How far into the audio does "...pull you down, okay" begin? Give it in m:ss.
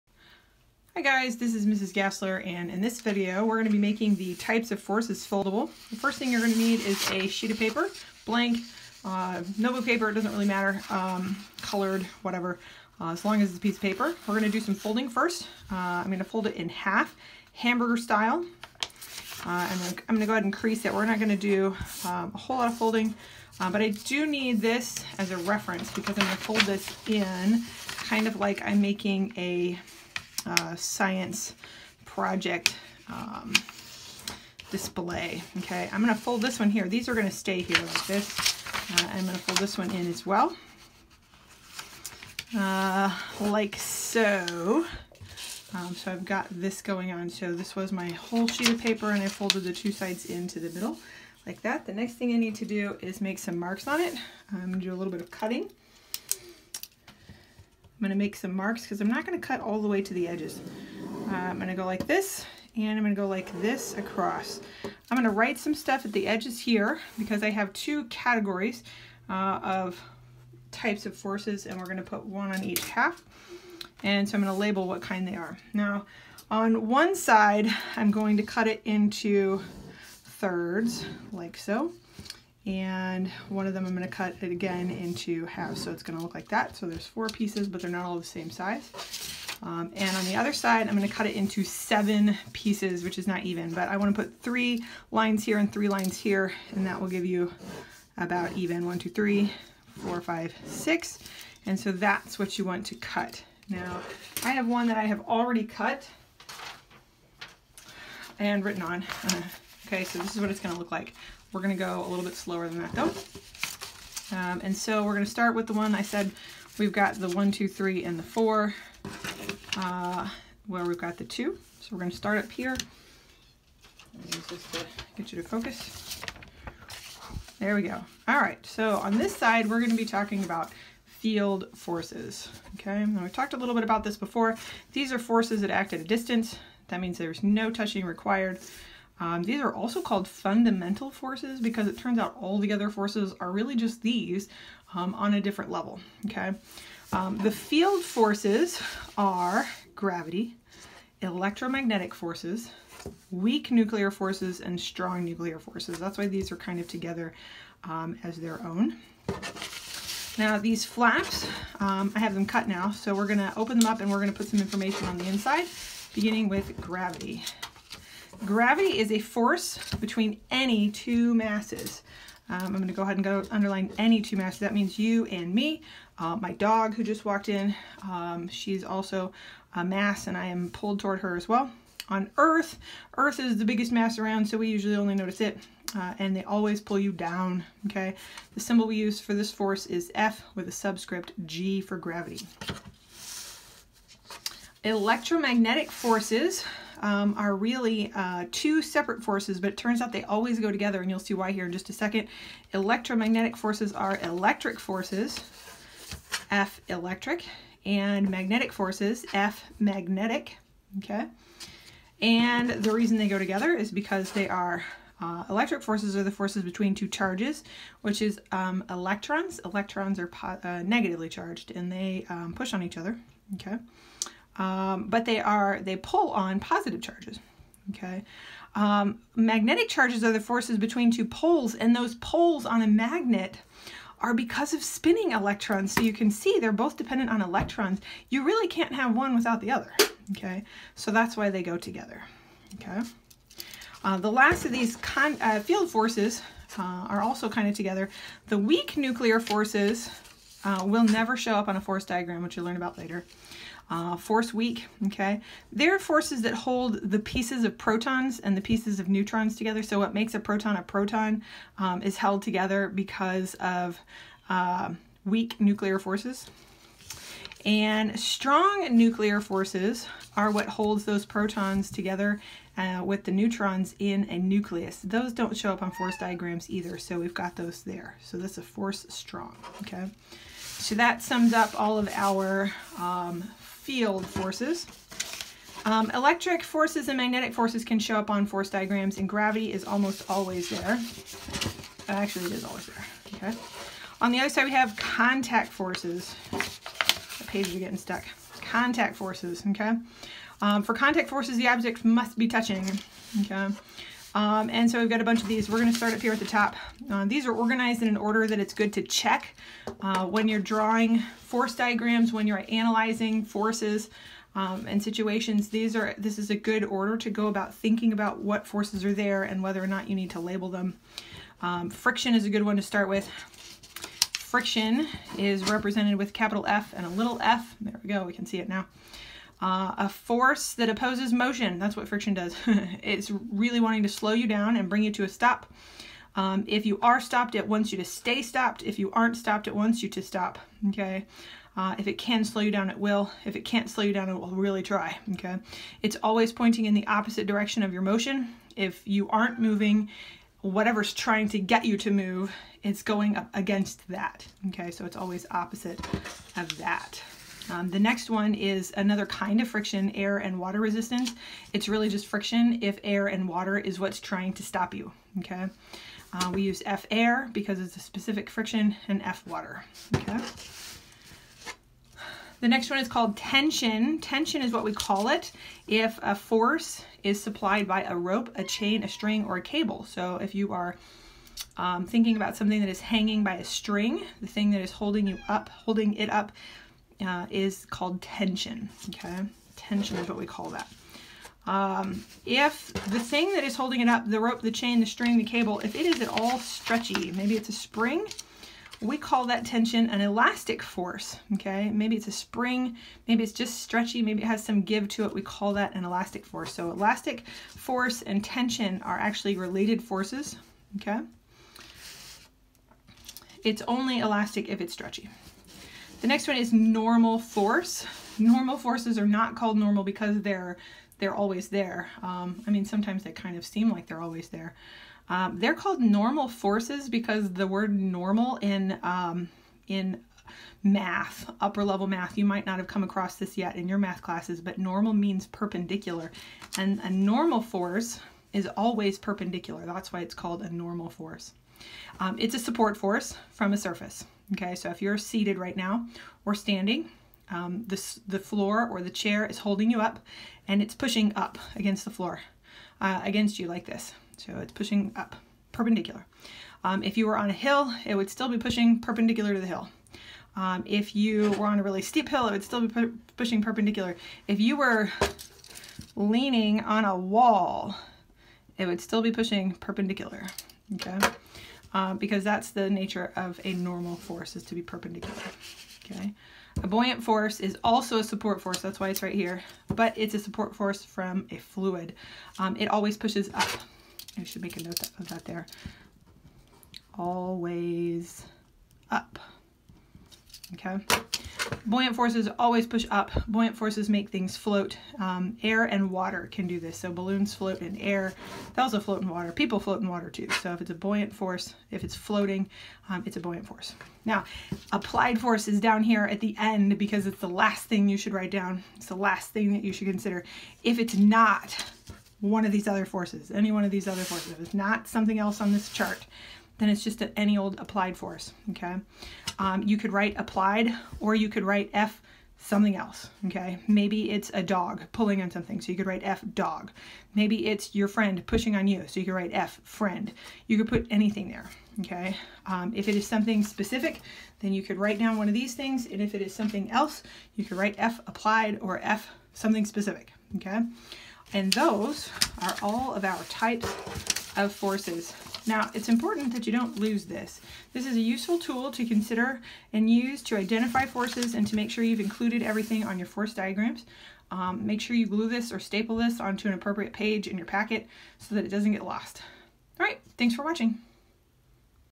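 3:06.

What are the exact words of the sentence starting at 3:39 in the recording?
Electrons are uh, negatively charged and they um, push on each other.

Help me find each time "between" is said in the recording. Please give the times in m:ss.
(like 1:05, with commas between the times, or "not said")
2:49, 3:36, 3:50.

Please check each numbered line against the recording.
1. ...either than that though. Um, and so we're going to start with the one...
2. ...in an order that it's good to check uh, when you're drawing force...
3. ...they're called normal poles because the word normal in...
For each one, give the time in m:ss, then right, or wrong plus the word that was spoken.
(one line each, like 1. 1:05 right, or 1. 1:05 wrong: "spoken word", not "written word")
1. 1:52 wrong: "slower", not "either"
2. 5:08 right
3. 7:05 wrong: "forces", not "poles".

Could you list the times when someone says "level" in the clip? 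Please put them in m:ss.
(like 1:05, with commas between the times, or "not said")
2:25, 7:11.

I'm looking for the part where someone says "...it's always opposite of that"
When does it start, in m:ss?
5:55.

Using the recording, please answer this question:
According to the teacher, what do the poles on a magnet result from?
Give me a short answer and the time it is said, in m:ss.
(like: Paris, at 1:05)
Spinning electrons, at 3:54.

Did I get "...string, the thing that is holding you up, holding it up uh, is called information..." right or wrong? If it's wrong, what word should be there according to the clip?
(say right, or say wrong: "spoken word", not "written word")
wrong: "tension", not "information".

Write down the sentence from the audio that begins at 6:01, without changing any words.
It's really just friction if air and water is what's trying to stop you, okay?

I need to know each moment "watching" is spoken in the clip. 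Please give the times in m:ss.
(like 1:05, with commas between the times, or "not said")
9:20.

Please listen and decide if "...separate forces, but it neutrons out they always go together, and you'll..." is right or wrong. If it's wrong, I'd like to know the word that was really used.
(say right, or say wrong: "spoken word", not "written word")
wrong: "turns", not "neutrons".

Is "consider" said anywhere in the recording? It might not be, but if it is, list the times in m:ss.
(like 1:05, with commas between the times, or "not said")
8:30, 9:09.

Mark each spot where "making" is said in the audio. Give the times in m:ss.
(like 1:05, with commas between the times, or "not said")
0:03, 0:28.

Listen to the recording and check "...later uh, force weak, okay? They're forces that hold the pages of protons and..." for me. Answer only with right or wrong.
wrong.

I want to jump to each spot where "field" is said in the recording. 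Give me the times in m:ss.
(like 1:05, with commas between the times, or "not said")
2:11, 2:27, 4:05, 4:43.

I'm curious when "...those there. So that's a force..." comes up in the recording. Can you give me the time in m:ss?
4:37.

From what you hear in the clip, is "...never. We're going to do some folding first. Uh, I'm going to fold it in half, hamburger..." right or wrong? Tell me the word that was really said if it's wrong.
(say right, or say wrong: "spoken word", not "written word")
wrong: "paper", not "never".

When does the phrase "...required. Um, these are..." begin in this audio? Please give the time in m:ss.
2:18.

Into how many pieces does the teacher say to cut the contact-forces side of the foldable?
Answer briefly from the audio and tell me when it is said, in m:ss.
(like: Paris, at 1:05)
7, at 1:31.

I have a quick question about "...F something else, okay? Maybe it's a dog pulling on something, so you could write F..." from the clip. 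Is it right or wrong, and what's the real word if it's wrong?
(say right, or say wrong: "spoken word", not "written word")
right.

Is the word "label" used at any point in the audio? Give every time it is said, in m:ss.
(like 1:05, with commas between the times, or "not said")
1:14, 5:20.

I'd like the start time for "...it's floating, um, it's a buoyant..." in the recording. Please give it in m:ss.
8:22.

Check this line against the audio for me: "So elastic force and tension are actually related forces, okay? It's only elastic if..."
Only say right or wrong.
right.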